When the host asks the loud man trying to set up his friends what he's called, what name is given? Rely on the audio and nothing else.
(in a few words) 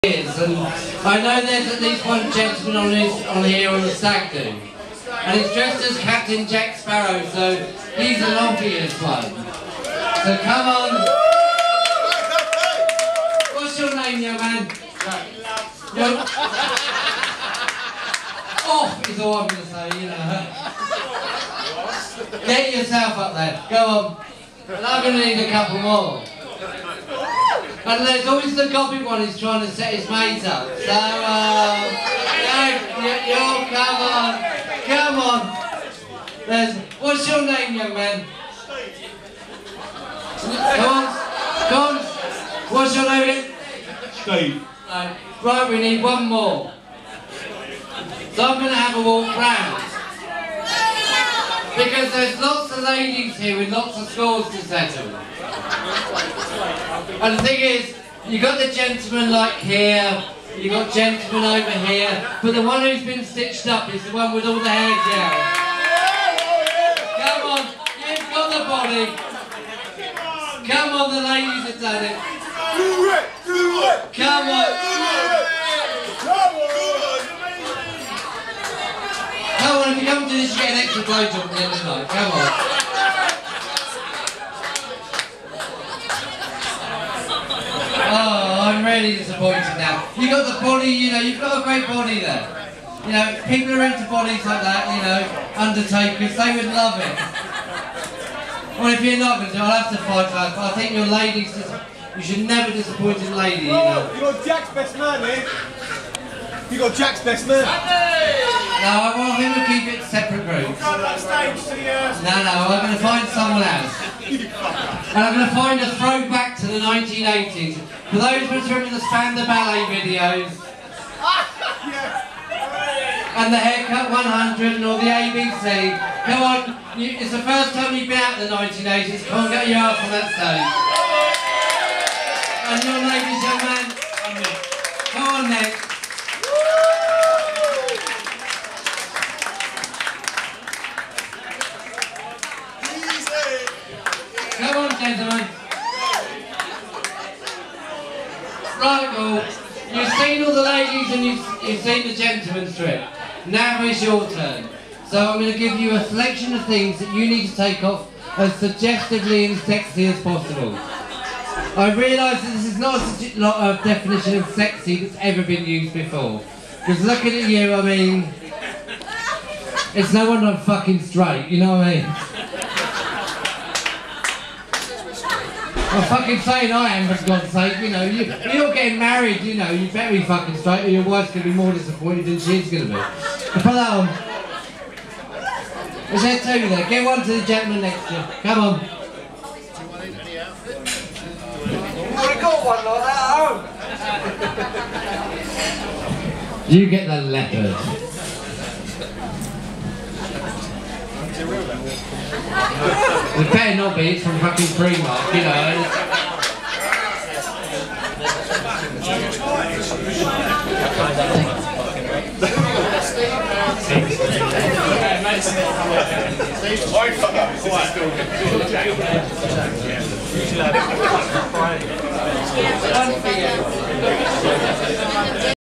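Steve.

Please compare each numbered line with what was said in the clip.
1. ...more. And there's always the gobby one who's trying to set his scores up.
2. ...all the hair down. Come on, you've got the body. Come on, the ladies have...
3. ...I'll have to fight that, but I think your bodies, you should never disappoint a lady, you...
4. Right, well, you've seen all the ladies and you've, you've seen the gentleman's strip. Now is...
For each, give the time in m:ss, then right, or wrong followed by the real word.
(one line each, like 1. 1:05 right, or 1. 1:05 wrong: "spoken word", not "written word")
1. 0:25 wrong: "mates", not "scores"
2. 1:04 right
3. 1:39 wrong: "ladies", not "bodies"
4. 2:28 right.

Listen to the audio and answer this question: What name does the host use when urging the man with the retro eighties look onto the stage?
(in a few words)
Nick.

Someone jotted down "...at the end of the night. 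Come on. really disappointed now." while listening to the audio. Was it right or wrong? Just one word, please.
right.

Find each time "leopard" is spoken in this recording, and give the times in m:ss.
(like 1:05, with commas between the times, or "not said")
3:17.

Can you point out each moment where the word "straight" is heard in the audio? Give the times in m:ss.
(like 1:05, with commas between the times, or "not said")
2:51, 3:00.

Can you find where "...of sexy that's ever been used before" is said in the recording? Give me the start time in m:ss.
2:44.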